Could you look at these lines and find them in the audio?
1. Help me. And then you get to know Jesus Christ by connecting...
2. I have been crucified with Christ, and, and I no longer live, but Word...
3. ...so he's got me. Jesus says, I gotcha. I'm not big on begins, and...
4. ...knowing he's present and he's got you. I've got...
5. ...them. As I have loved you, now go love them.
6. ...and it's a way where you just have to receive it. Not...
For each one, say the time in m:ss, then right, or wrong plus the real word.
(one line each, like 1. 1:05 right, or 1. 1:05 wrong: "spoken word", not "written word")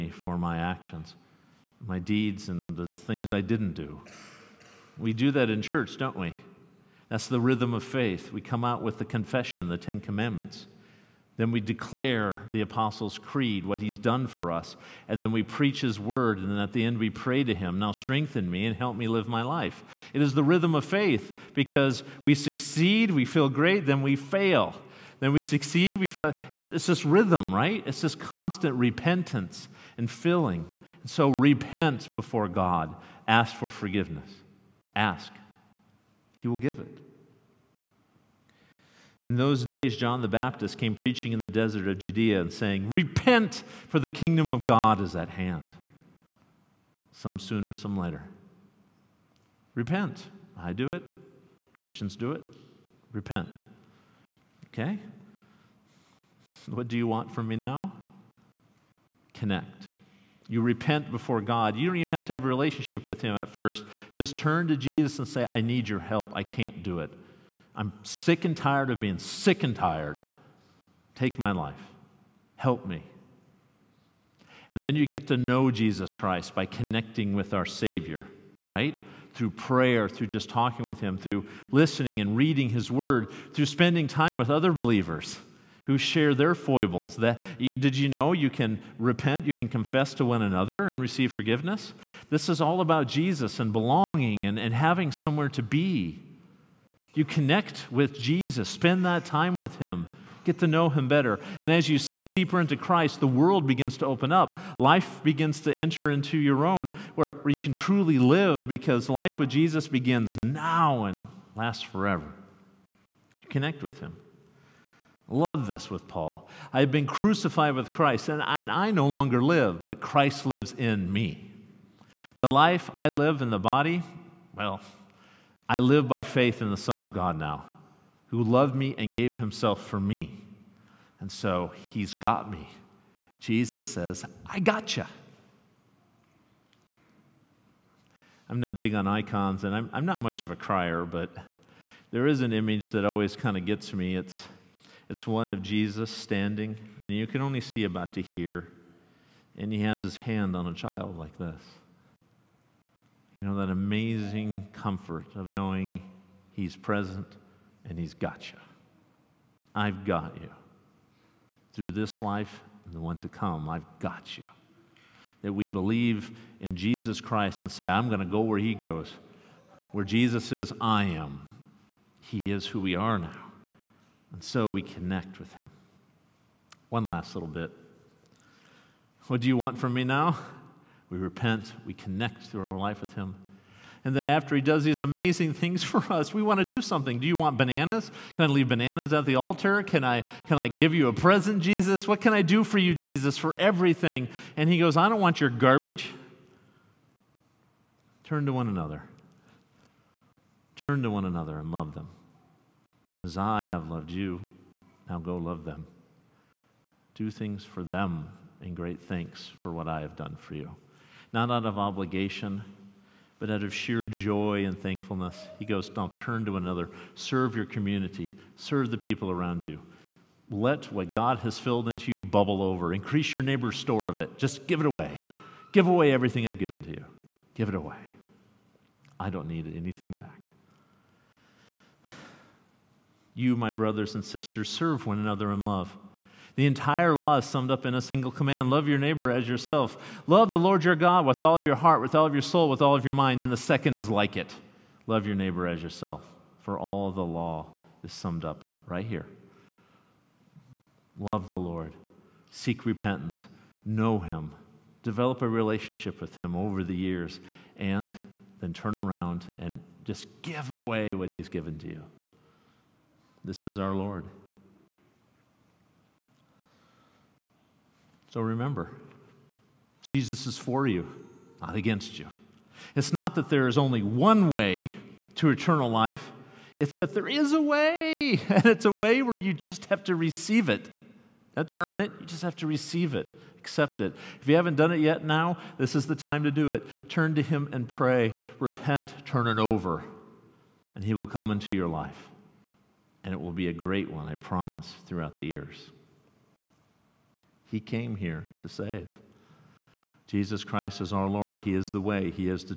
1. 1:12 right
2. 1:56 wrong: "Christ", not "Word"
3. 2:11 wrong: "icons", not "begins"
4. 2:35 right
5. 3:21 right
6. 4:38 right.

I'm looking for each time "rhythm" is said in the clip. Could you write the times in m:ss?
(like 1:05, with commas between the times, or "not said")
0:07, 0:20, 0:27.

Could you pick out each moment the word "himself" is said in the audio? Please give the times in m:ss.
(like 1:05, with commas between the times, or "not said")
2:09.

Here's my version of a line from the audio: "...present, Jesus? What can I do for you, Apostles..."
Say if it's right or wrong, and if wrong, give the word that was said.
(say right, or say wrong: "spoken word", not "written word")
wrong: "Jesus", not "Apostles".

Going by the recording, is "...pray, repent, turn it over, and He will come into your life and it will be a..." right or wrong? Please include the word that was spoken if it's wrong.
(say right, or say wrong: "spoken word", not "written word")
right.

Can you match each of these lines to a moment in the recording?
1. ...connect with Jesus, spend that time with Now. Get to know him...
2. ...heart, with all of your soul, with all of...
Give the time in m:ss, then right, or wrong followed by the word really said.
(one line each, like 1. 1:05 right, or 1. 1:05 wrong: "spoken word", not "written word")
1. 1:37 wrong: "Him", not "Now"
2. 4:01 right.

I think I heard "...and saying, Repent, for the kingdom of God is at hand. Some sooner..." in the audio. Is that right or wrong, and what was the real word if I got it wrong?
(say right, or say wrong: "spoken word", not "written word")
right.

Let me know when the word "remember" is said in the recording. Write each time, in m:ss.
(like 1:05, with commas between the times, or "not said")
4:28.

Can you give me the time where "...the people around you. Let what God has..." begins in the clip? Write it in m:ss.
3:38.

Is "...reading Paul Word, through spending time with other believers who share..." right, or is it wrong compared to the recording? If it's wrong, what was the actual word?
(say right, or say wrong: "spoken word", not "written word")
wrong: "His", not "Paul".